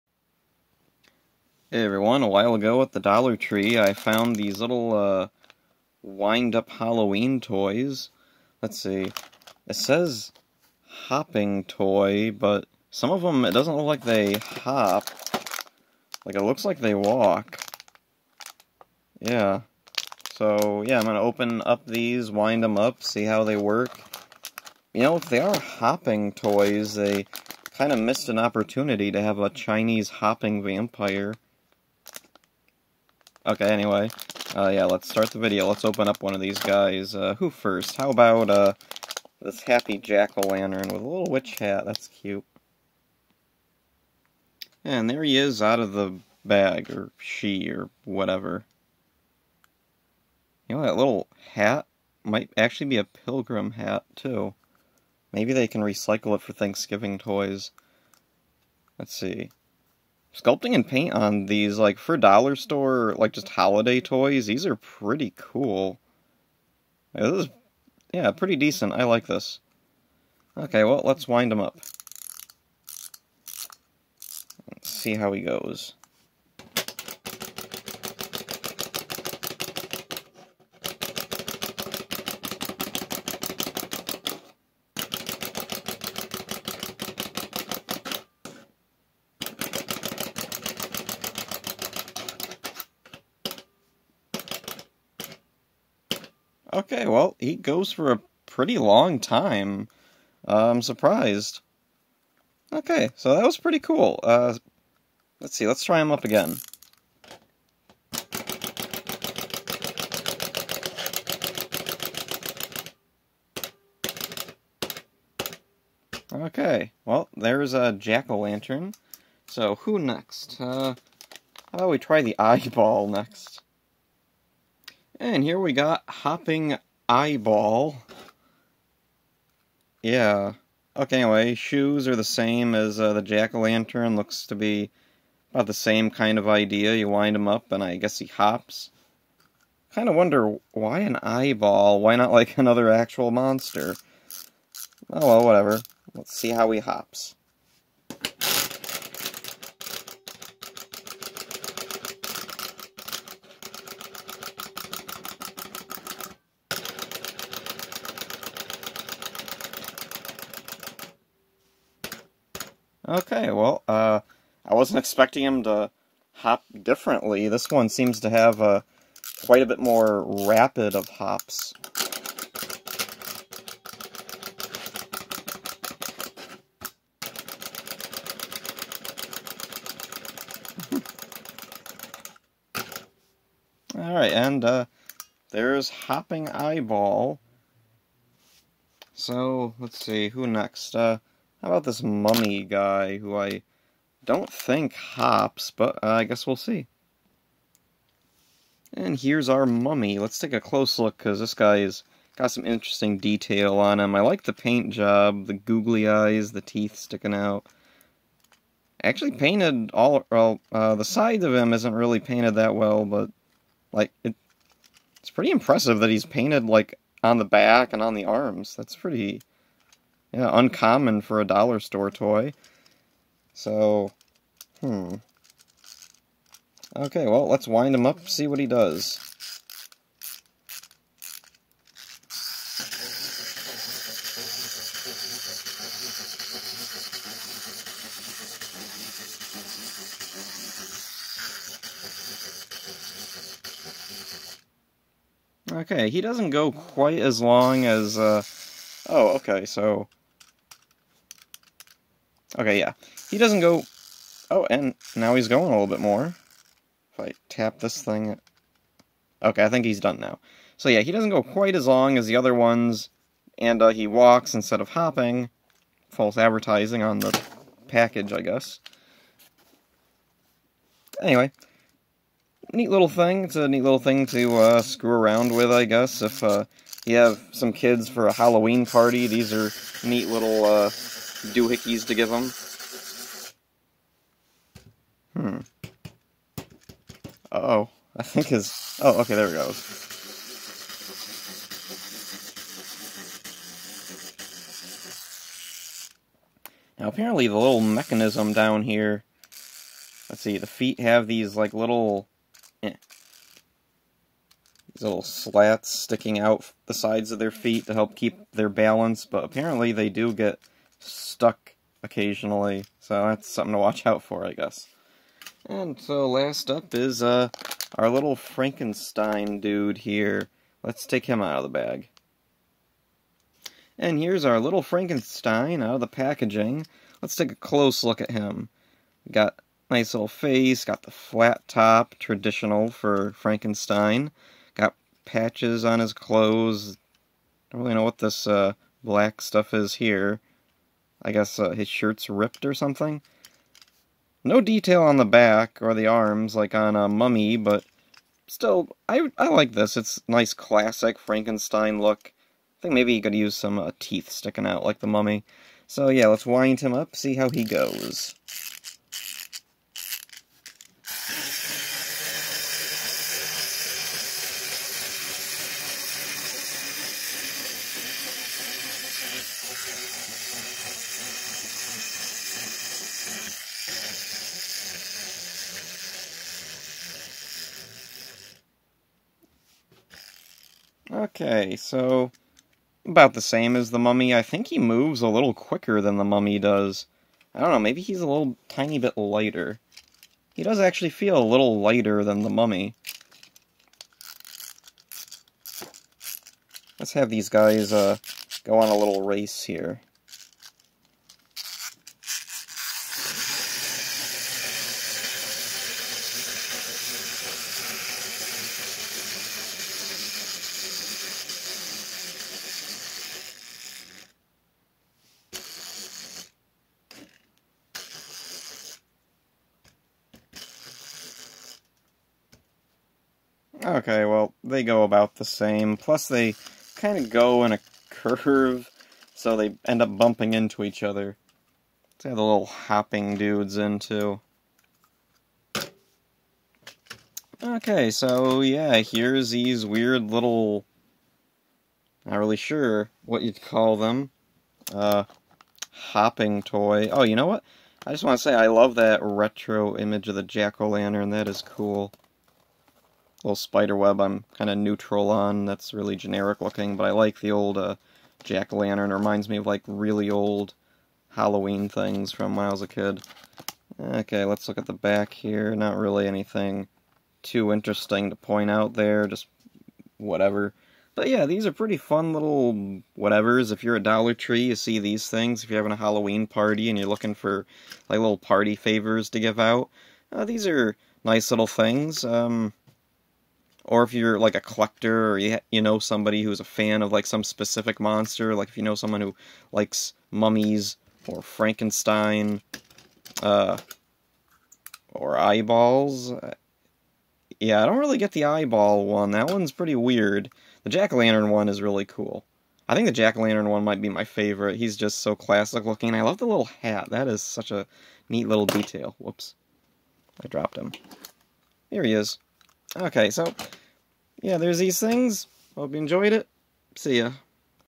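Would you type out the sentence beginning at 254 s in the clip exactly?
Oh, and now he's going a little bit more.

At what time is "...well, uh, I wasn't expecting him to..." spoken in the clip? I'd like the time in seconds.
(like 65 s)
163 s.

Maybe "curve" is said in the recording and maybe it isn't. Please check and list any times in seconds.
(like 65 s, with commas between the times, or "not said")
428 s.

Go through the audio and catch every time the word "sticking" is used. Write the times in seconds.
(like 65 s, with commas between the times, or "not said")
206 s, 305 s, 354 s.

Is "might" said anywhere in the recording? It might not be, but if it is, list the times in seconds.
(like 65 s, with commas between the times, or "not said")
52 s, 503 s.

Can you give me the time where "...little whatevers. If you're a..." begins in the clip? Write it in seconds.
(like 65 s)
472 s.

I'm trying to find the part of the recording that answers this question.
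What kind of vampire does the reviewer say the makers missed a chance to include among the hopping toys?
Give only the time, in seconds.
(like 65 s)
29 s.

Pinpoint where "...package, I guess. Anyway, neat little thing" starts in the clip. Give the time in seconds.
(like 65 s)
267 s.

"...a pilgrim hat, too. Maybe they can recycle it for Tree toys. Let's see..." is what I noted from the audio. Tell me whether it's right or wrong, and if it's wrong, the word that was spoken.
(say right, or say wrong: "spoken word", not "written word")
wrong: "Thanksgiving", not "Tree".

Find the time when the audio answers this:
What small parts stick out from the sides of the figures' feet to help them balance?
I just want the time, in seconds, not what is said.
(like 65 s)
305 s.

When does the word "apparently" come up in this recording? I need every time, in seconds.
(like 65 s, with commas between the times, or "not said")
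297 s, 309 s.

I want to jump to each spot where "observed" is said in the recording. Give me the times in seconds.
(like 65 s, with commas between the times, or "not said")
not said.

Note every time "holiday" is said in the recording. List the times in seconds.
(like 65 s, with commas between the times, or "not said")
63 s.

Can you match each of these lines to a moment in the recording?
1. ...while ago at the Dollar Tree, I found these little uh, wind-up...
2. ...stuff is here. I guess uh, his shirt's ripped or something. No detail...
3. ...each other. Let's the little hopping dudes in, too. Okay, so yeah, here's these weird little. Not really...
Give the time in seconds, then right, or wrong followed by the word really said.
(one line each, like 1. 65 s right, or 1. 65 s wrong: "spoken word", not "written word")
1. 2 s right
2. 339 s right
3. 430 s right.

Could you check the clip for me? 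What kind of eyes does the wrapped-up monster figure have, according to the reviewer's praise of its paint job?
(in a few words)
googly eyes.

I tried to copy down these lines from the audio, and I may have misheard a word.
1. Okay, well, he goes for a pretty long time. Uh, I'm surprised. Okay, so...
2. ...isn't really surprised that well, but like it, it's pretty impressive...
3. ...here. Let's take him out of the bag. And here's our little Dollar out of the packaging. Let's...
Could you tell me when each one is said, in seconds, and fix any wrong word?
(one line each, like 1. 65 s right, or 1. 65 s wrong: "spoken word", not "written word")
1. 96 s right
2. 211 s wrong: "painted", not "surprised"
3. 319 s wrong: "Frankenstein", not "Dollar".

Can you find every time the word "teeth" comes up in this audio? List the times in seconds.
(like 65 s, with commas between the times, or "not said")
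206 s, 353 s.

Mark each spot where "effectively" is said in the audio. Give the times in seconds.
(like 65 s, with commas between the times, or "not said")
not said.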